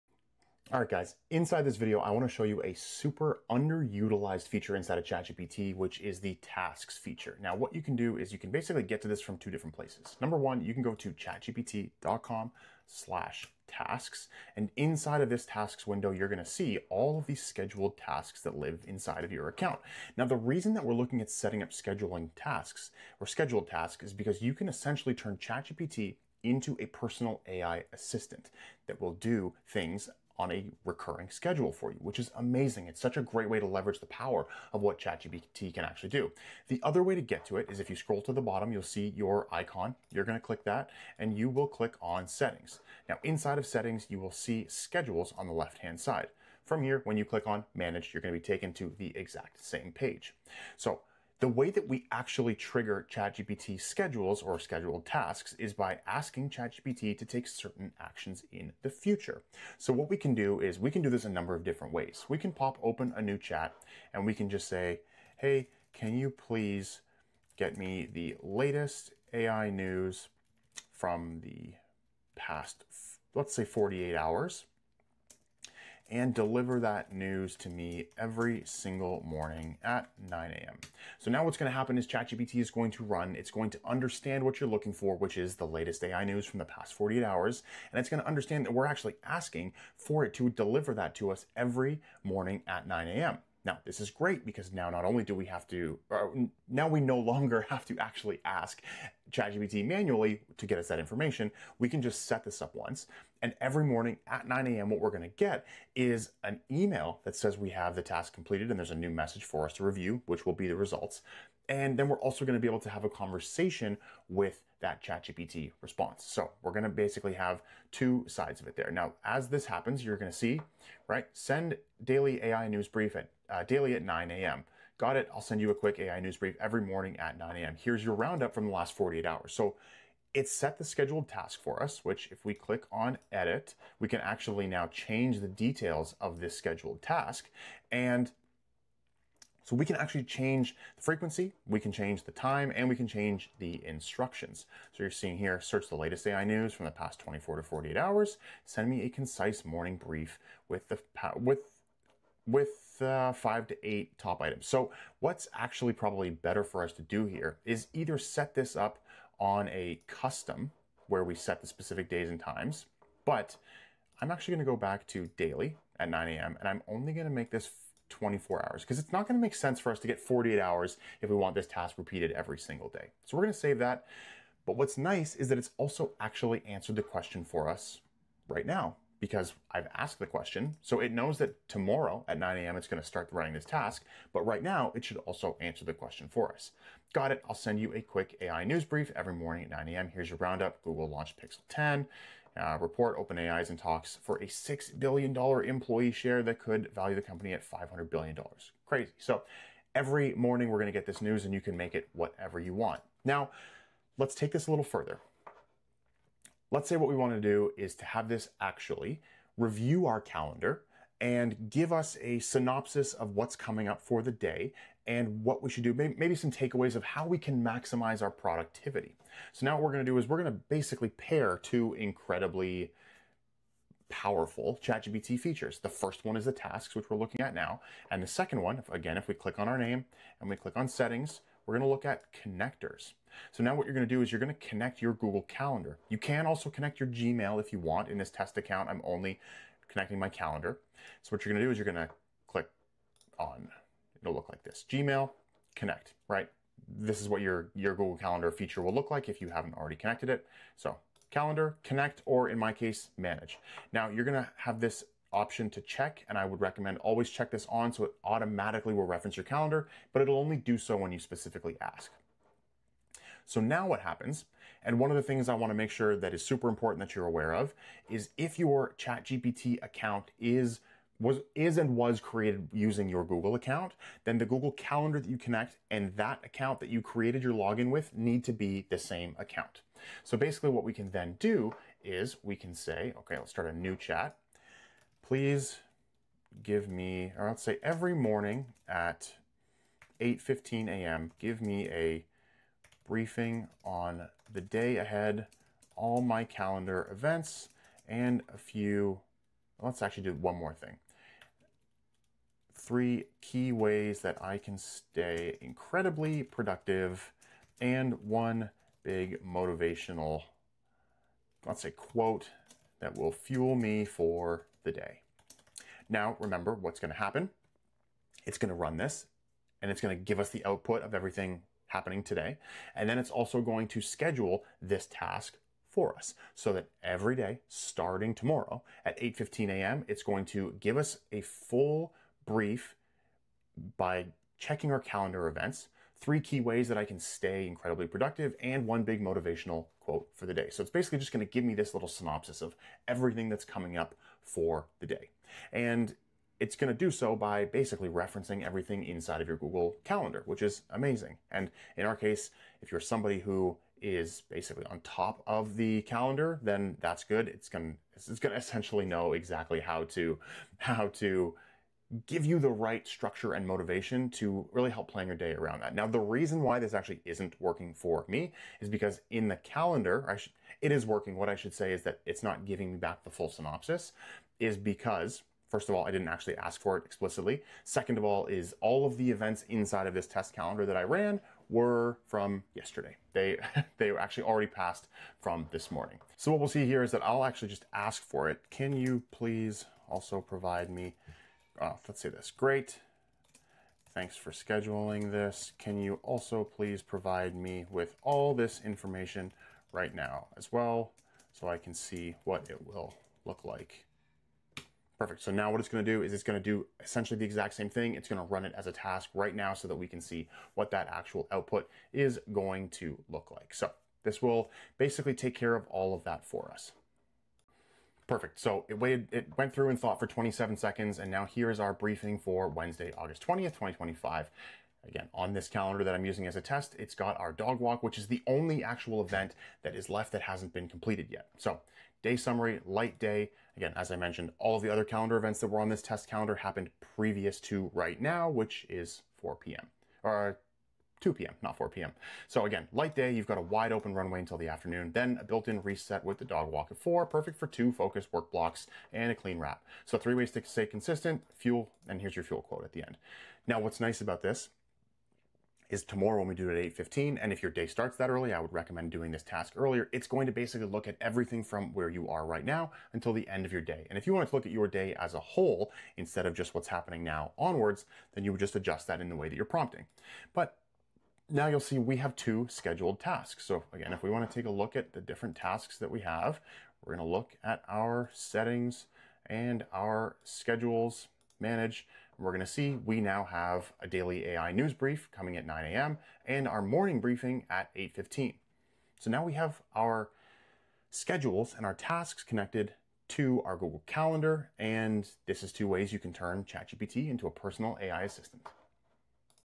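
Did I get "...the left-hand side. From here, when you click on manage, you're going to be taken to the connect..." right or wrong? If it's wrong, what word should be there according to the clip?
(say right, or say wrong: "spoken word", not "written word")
wrong: "exact", not "connect".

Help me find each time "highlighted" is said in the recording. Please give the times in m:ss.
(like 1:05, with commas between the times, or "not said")
not said.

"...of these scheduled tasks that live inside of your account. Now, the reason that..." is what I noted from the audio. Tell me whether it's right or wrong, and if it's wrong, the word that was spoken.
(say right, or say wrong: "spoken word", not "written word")
right.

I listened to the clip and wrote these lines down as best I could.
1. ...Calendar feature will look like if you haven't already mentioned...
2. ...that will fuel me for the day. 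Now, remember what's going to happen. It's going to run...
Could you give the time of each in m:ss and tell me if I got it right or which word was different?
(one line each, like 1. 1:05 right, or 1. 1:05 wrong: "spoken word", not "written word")
1. 4:08 wrong: "connected", not "mentioned"
2. 5:12 right.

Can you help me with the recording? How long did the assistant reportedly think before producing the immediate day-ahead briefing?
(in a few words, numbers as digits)
27 seconds.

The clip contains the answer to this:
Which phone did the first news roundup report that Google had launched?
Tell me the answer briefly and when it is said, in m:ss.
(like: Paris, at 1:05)
Pixel 10, at 3:11.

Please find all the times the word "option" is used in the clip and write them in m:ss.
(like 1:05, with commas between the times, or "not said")
4:15.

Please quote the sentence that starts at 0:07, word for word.
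Now, what you can do is you can basically get to this from two different places.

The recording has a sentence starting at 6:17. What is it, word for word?
Second of all is all of the events inside of this test calendar that I ran were from yesterday.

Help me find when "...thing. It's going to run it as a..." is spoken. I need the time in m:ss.
6:47.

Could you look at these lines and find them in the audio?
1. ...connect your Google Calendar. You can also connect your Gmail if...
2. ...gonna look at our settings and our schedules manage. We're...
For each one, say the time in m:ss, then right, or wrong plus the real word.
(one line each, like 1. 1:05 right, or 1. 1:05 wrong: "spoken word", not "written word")
1. 3:54 right
2. 7:57 right.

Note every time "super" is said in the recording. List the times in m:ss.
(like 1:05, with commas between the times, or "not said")
0:02, 4:26.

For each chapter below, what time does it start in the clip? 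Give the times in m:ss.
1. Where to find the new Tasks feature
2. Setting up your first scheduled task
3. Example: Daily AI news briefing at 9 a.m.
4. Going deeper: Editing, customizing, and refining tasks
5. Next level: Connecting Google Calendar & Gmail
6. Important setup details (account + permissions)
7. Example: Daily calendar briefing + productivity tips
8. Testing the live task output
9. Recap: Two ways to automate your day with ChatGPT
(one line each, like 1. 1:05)
1. 0:20
2. 1:00
3. 1:45
4. 3:21
5. 3:40
6. 4:40
7. 5:17
8. 6:45
9. 7:40.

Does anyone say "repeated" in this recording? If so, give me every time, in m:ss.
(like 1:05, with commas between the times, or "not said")
2:51.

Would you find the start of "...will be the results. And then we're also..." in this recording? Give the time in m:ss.
1:50.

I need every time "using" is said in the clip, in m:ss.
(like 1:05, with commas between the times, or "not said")
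4:32, 7:06.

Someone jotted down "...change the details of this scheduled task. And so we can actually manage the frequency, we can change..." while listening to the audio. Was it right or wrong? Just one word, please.
wrong.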